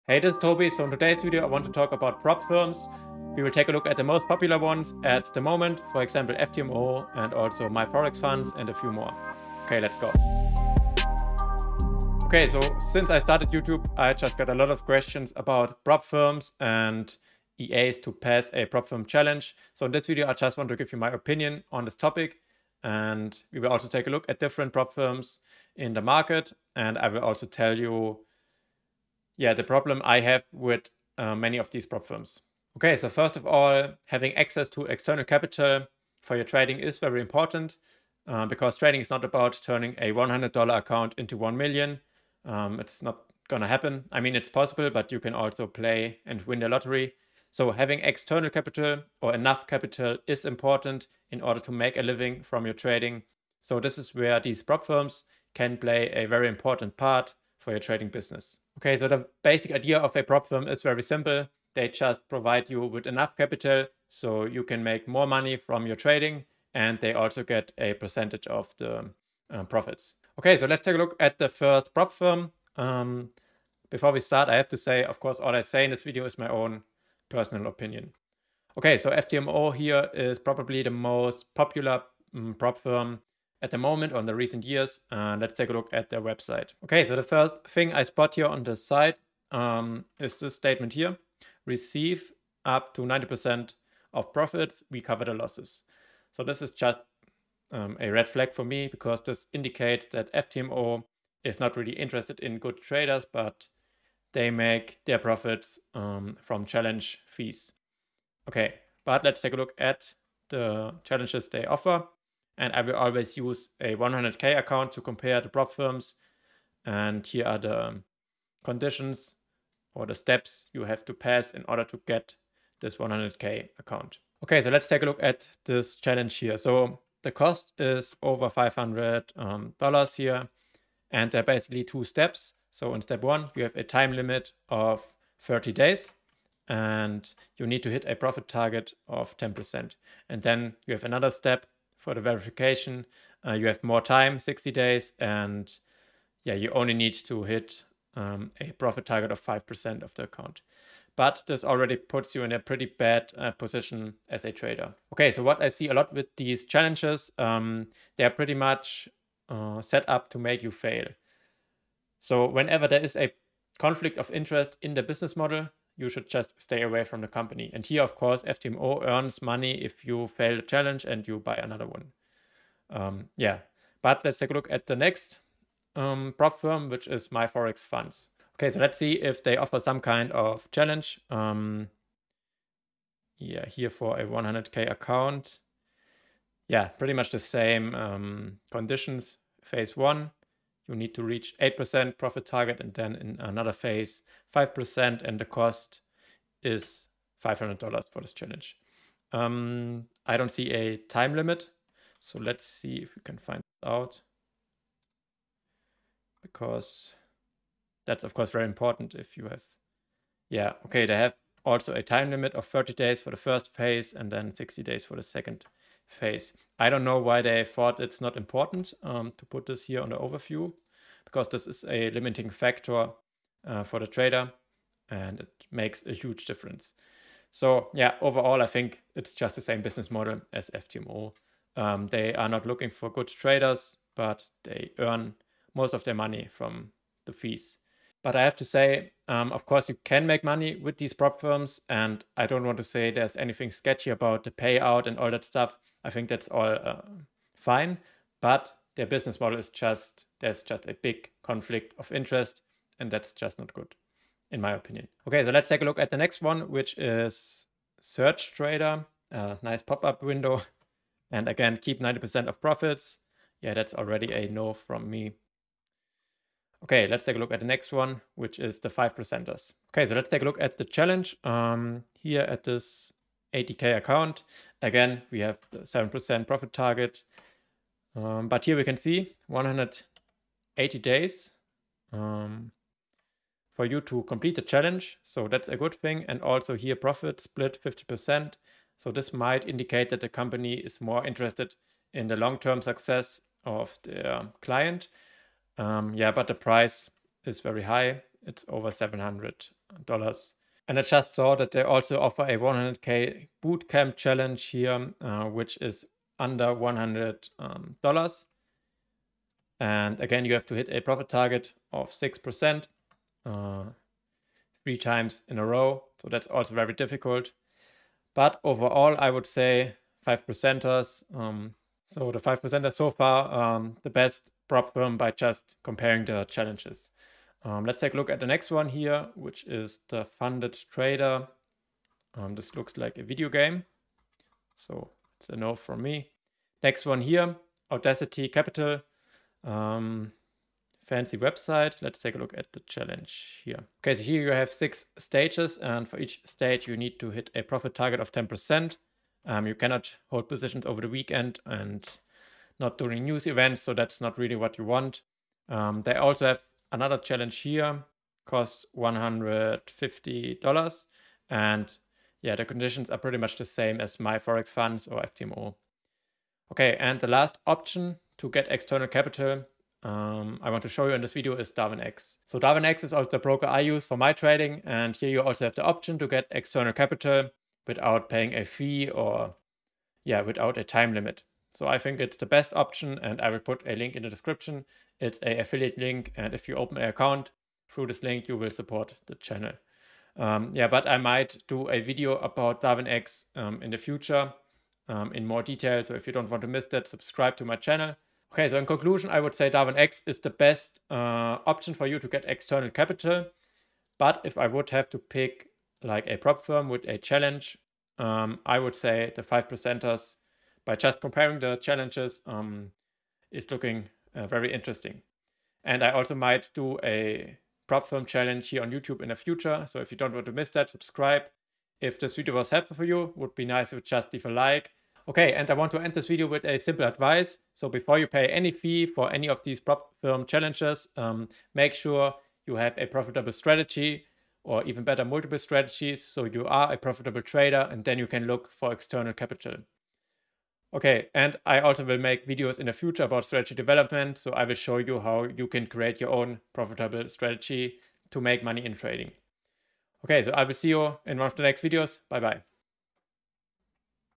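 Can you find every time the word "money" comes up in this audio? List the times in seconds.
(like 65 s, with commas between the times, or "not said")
65 s, 169 s, 236 s, 240 s, 448 s.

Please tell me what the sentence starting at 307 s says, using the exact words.
Um, and again, you have to hit a profit target of 6% uh, three times in a row.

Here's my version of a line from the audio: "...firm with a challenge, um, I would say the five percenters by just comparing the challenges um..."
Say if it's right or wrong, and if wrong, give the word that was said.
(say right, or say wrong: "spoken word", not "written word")
right.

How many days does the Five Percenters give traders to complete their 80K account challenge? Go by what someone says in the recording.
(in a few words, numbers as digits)
180 days.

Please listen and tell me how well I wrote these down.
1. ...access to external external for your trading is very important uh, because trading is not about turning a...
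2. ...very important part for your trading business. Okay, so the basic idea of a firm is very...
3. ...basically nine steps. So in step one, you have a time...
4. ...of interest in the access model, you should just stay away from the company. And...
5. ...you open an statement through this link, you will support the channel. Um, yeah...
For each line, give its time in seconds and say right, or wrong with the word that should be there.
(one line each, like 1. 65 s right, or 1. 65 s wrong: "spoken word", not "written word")
1. 34 s wrong: "capital", not "external"
2. 56 s right
3. 131 s wrong: "two", not "nine"
4. 164 s wrong: "business", not "access"
5. 386 s wrong: "account", not "statement".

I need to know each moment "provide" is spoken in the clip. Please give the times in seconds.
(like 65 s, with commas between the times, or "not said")
62 s.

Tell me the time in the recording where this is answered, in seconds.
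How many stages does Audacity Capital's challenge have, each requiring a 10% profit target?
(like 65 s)
344 s.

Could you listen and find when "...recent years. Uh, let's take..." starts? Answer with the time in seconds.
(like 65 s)
84 s.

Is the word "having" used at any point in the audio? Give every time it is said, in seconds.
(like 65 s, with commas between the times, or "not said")
34 s, 47 s.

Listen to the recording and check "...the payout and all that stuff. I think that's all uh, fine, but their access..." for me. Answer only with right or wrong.
wrong.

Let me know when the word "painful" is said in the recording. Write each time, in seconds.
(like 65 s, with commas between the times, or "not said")
not said.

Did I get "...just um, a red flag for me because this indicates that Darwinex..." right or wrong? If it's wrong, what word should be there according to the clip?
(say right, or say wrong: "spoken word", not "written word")
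wrong: "FTMO", not "Darwinex".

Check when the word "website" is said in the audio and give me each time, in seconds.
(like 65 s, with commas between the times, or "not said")
86 s, 341 s.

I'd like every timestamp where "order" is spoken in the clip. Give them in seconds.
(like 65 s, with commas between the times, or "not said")
51 s, 121 s.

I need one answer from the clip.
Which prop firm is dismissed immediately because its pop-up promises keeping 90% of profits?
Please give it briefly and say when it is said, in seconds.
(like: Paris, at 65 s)
SurgeTrader, at 258 s.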